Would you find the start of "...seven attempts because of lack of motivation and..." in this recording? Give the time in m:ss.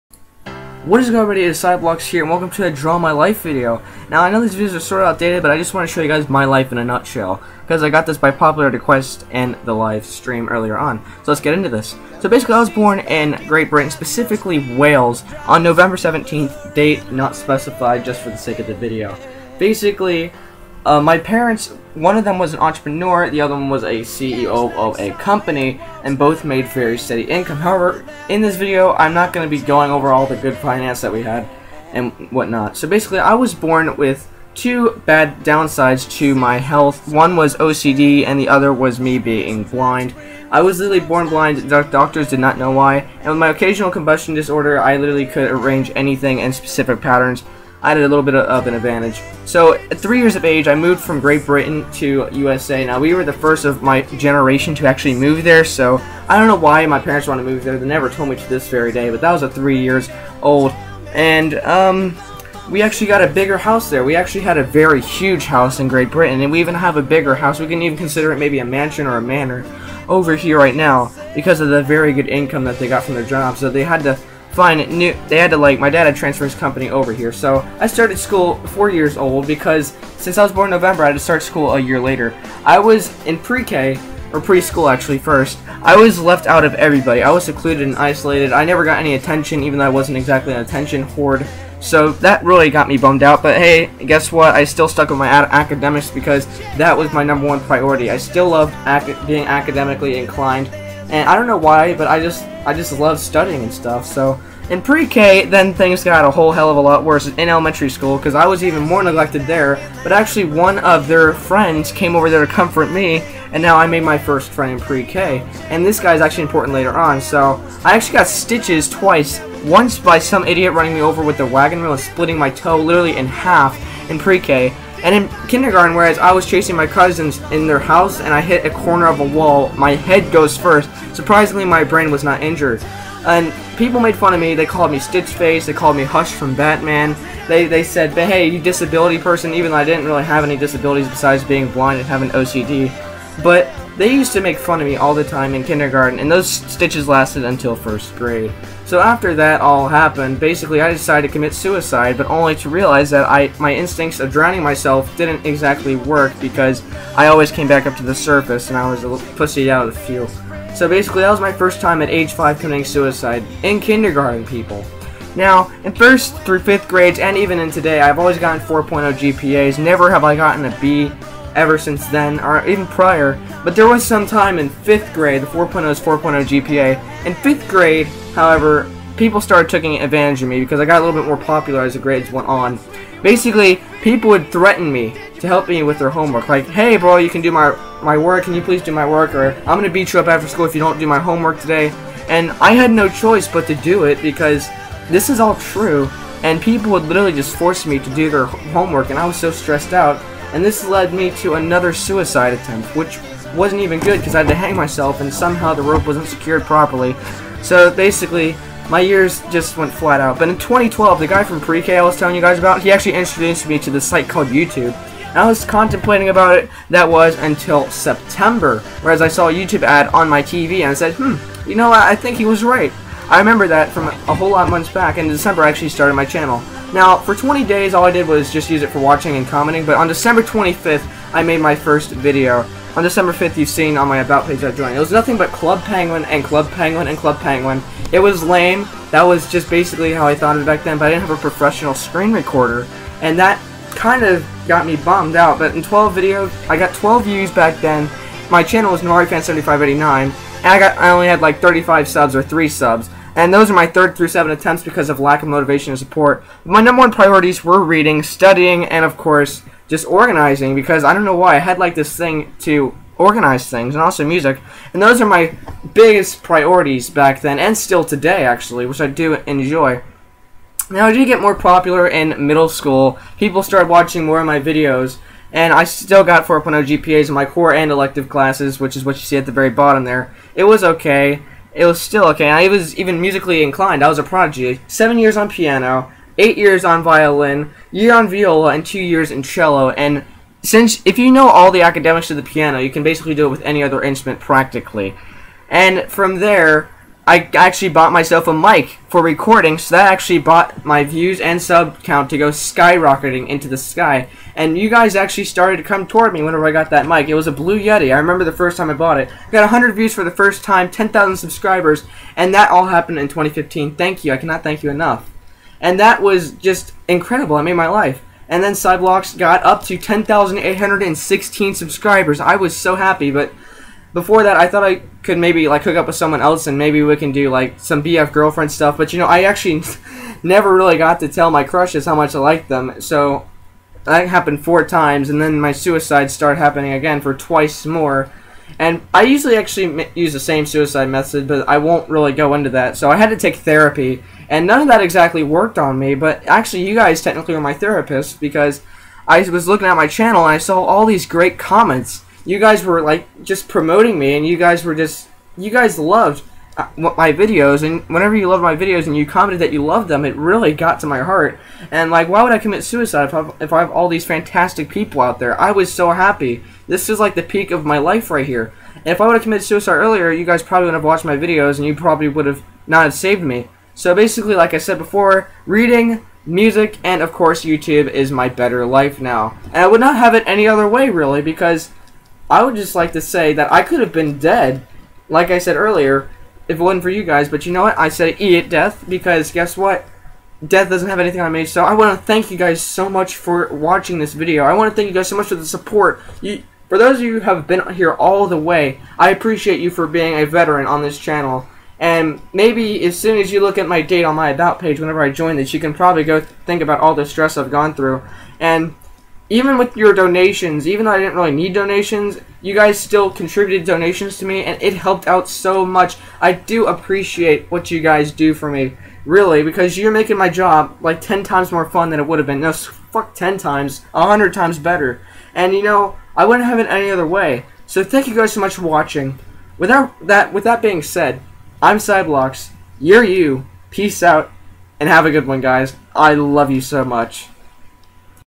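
4:14.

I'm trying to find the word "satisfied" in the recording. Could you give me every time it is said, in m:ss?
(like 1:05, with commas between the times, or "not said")
not said.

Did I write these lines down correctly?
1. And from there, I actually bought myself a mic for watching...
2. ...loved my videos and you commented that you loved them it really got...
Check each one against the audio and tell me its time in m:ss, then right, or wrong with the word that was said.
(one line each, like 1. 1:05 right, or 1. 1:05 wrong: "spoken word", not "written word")
1. 4:55 wrong: "recording", not "watching"
2. 5:58 right.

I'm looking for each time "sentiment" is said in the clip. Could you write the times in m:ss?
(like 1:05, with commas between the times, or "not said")
not said.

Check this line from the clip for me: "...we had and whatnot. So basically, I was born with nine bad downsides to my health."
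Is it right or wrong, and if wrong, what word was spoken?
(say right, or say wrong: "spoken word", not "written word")
wrong: "two", not "nine".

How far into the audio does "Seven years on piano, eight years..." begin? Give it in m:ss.
4:44.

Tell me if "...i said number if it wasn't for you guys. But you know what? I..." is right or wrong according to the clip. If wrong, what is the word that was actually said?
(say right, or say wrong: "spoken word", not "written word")
wrong: "earlier", not "number".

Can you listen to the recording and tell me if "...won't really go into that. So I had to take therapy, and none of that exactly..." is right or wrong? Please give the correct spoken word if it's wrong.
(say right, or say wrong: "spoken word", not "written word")
right.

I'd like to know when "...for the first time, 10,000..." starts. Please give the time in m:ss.
5:10.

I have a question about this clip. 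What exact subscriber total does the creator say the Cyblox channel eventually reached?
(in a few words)
10,816.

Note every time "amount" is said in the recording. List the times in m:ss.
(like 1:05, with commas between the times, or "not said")
not said.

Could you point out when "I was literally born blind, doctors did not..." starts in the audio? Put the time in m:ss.
0:40.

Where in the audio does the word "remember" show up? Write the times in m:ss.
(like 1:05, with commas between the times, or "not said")
3:43, 5:08.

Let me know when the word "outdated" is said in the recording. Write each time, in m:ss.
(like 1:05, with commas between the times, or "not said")
0:05.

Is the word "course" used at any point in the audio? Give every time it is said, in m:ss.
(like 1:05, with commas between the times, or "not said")
4:19, 6:17.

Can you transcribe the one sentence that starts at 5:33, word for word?
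So that happened four times, and then my suicides started happening again for twice more.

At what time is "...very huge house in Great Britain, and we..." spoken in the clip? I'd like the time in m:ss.
1:04.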